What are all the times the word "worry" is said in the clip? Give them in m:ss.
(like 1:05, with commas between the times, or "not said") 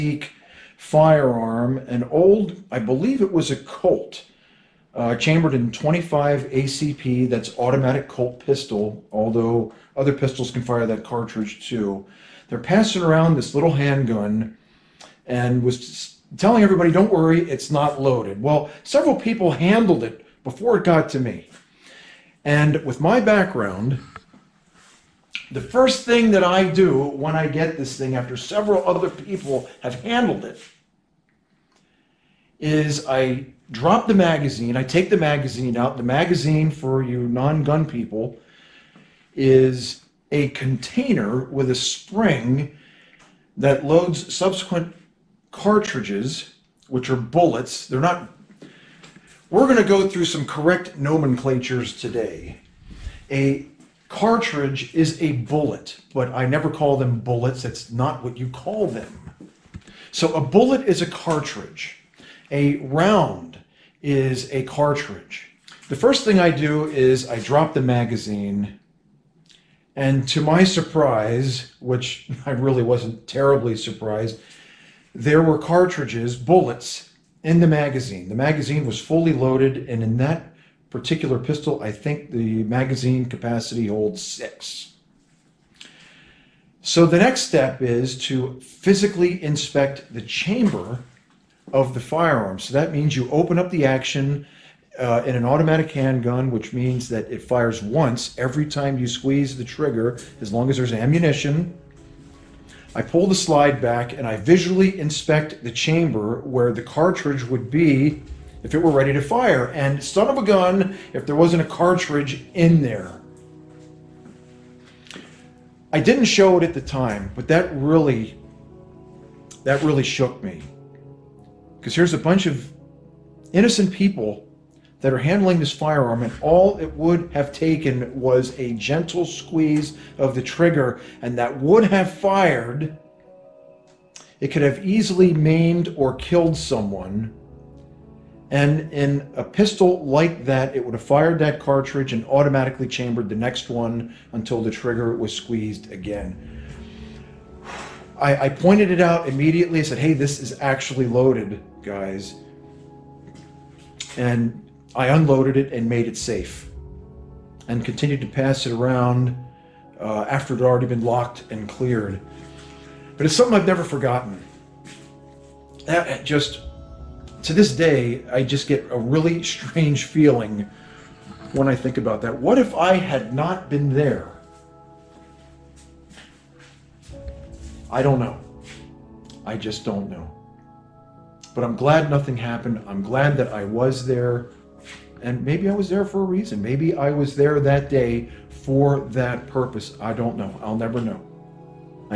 0:17.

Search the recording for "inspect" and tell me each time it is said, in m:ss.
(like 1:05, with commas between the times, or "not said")
1:29, 1:44.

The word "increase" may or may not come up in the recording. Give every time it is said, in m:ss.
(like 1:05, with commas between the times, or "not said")
not said.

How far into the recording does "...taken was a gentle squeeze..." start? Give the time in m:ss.
2:07.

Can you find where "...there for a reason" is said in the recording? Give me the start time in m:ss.
3:05.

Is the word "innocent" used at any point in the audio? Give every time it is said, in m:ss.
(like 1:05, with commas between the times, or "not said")
2:03.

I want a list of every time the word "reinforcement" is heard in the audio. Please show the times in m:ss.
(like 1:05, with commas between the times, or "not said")
not said.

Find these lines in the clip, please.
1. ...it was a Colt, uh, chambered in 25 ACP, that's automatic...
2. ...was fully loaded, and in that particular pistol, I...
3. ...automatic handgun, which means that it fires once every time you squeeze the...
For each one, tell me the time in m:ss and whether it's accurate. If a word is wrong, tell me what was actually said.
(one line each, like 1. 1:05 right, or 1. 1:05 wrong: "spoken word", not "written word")
1. 0:03 right
2. 1:18 right
3. 1:35 right.